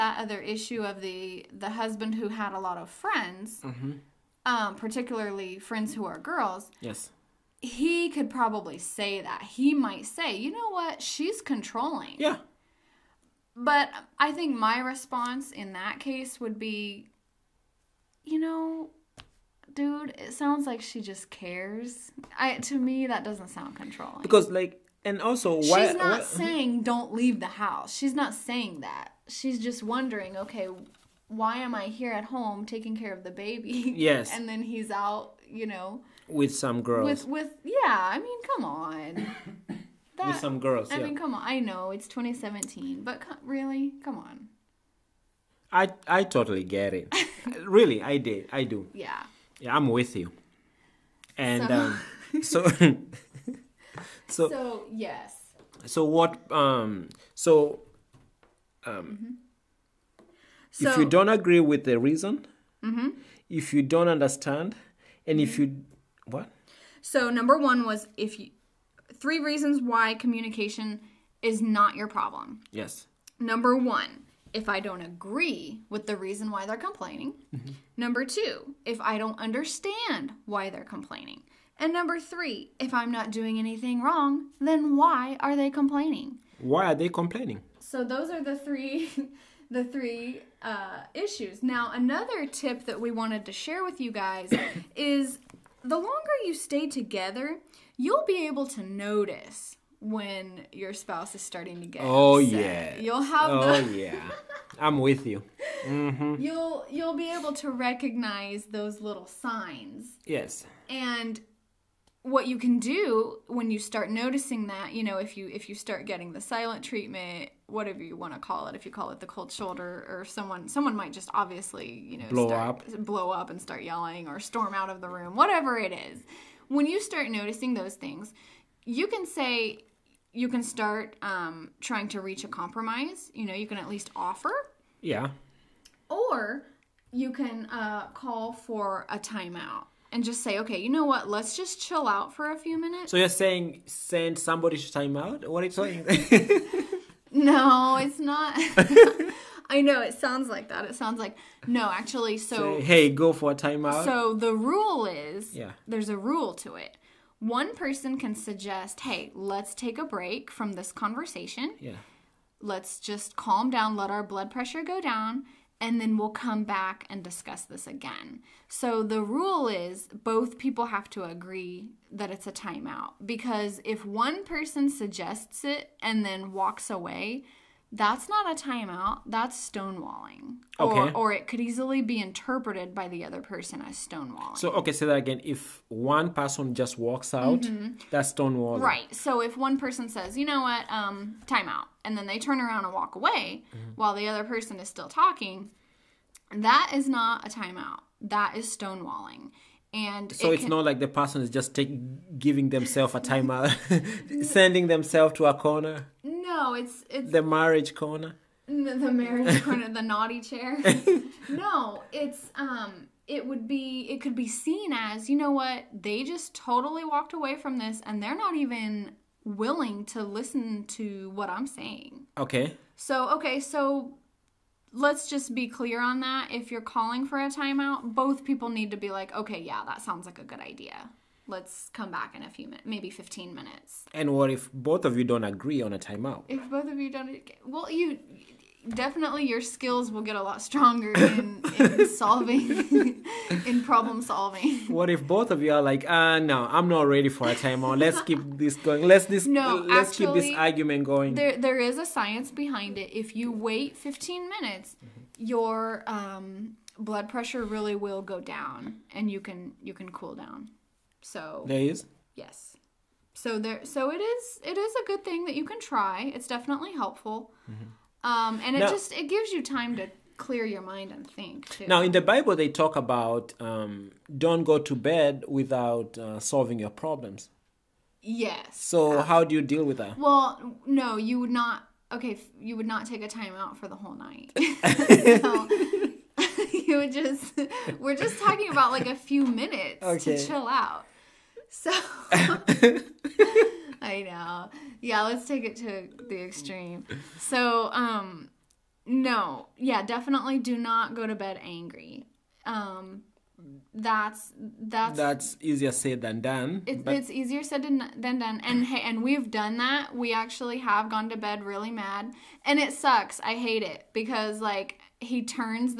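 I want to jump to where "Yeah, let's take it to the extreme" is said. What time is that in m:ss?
4:55.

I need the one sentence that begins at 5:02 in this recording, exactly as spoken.
Um that's that's that's easier said than done.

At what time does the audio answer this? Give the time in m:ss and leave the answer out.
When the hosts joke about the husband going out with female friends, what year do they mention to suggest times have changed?
0:42.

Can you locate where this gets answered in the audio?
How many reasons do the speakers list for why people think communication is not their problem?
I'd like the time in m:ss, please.
1:09.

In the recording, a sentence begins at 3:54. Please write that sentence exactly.
And what if both of you don't agree on a timeout?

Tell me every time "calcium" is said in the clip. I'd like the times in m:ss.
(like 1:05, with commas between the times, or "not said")
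not said.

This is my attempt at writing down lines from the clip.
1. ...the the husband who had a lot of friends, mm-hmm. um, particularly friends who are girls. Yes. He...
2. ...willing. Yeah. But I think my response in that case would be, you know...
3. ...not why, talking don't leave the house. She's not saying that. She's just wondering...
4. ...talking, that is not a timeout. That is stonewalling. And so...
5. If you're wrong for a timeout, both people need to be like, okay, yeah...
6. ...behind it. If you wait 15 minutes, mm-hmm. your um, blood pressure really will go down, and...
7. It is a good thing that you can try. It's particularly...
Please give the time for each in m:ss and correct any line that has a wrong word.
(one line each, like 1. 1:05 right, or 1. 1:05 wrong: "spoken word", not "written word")
1. 0:00 right
2. 0:11 wrong: "controlling", not "willing"
3. 0:25 wrong: "saying", not "talking"
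4. 3:15 right
5. 3:46 wrong: "calling", not "wrong"
6. 4:12 right
7. 4:24 wrong: "definitely", not "particularly".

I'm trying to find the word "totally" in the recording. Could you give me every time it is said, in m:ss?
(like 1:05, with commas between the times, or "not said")
0:46, 3:36.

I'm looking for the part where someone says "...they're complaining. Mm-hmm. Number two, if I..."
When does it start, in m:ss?
1:16.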